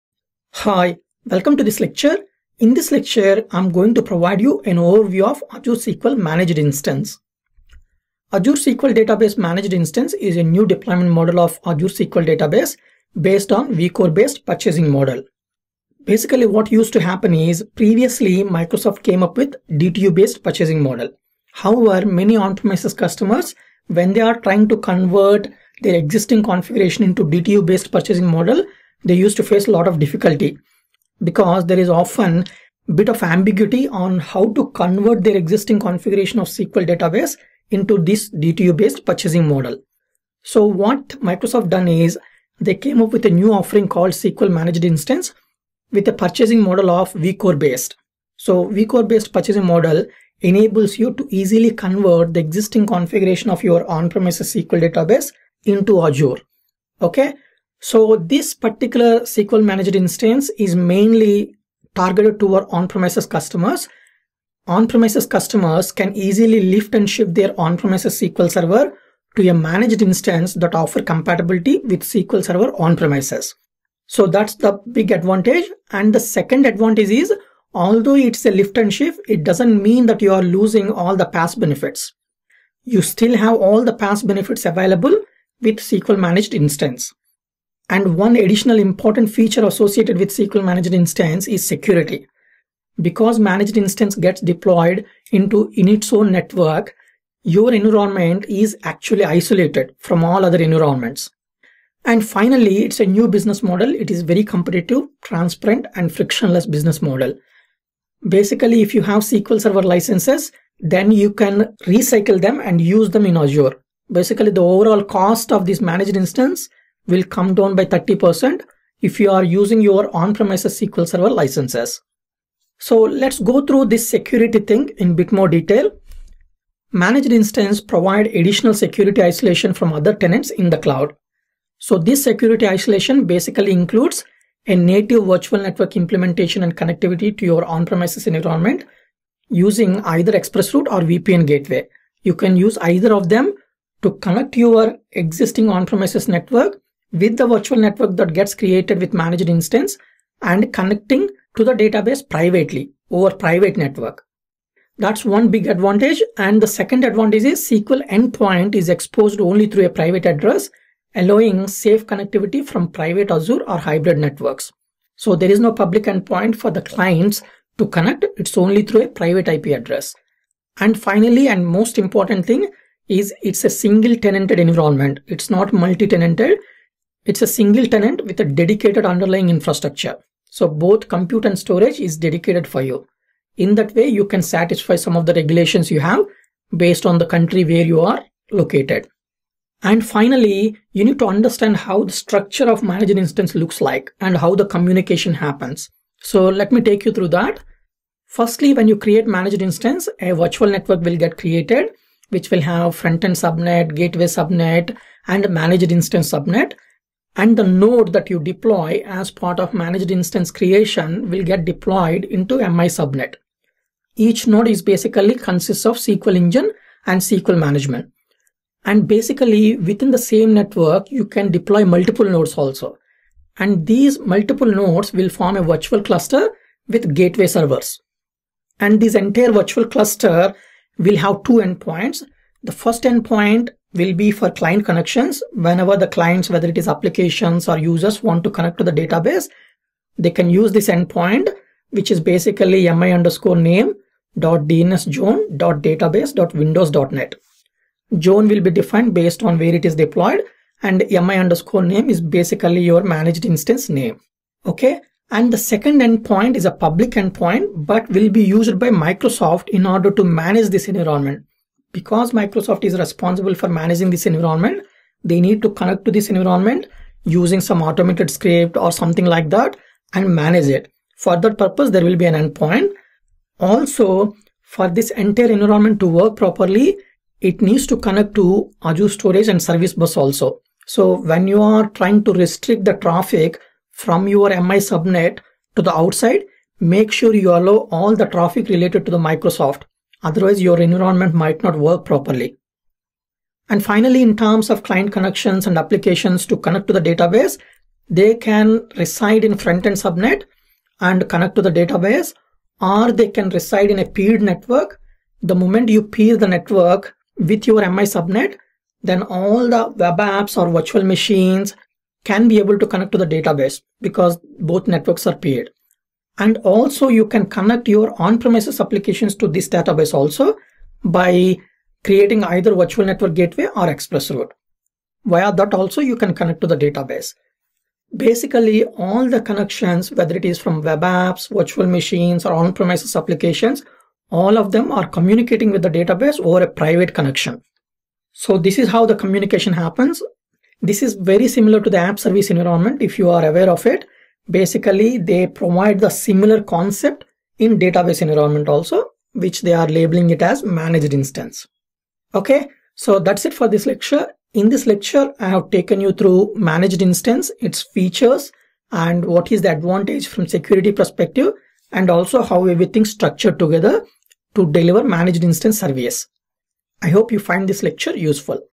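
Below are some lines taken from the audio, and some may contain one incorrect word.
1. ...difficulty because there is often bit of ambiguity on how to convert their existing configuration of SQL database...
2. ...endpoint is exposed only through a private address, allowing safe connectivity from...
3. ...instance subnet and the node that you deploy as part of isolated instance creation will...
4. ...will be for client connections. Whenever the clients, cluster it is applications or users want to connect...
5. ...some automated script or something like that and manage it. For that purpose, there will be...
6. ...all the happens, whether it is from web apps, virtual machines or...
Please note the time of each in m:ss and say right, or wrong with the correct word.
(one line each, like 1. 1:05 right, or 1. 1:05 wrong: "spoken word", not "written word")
1. 0:29 right
2. 2:38 right
3. 3:25 wrong: "managed", not "isolated"
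4. 3:53 wrong: "whether", not "cluster"
5. 4:27 right
6. 5:29 wrong: "connections", not "happens".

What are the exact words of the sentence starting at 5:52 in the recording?
Okay, so that's it for this lecture.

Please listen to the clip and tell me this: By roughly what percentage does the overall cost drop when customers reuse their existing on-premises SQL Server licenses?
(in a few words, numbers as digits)
30%.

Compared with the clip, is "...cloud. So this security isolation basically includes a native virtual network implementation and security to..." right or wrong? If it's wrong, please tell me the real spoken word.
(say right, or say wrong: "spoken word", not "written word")
wrong: "connectivity", not "security".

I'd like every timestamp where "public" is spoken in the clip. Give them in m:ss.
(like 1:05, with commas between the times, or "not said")
2:45, 4:16.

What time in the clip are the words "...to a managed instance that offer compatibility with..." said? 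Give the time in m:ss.
1:09.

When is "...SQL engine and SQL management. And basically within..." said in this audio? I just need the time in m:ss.
3:35.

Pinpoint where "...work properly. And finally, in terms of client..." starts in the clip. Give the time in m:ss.
4:51.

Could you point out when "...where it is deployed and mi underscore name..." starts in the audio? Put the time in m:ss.
4:09.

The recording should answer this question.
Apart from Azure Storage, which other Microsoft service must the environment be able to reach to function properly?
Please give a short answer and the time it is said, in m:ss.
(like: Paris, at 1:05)
Service Bus, at 4:39.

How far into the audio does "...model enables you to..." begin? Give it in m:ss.
0:49.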